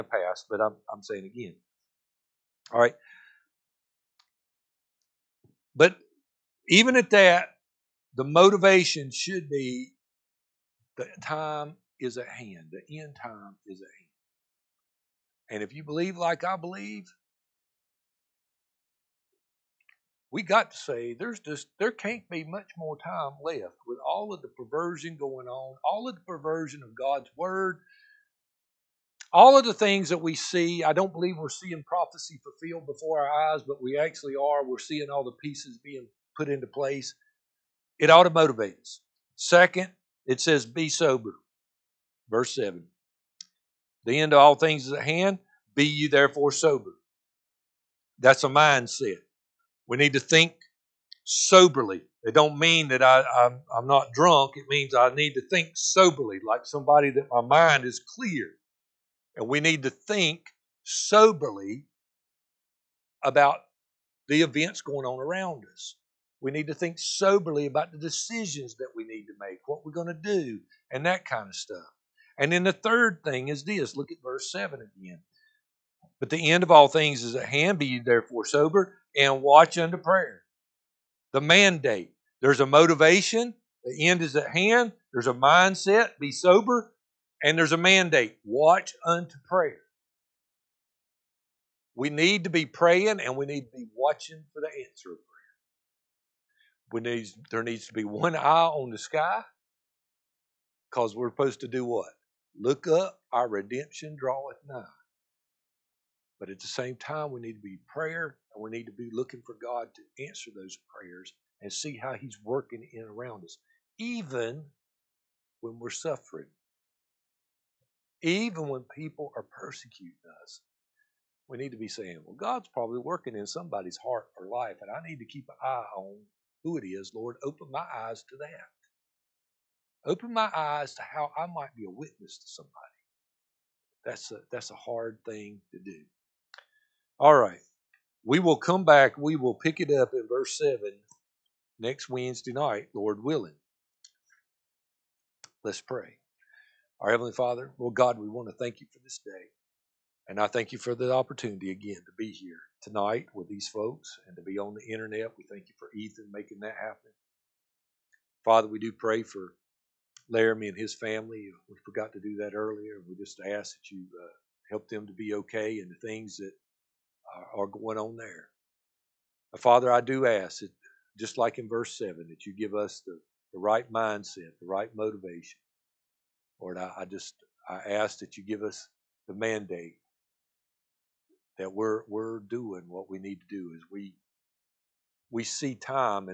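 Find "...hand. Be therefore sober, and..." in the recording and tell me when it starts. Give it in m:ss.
1:17.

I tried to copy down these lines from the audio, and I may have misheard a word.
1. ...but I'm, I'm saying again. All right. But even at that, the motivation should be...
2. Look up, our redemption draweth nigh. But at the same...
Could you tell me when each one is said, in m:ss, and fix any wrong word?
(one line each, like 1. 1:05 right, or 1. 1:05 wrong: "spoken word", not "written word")
1. 0:00 right
2. 1:42 right.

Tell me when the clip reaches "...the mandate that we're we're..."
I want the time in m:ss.
2:59.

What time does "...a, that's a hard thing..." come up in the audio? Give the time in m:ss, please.
2:14.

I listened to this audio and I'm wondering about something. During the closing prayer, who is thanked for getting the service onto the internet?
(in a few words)
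Ethan.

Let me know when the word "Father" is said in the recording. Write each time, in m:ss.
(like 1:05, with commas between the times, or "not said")
2:27, 2:38, 2:49.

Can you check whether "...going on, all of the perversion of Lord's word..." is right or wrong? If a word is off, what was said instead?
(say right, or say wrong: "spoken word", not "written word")
wrong: "God", not "Lord".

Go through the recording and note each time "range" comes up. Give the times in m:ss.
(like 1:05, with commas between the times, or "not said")
not said.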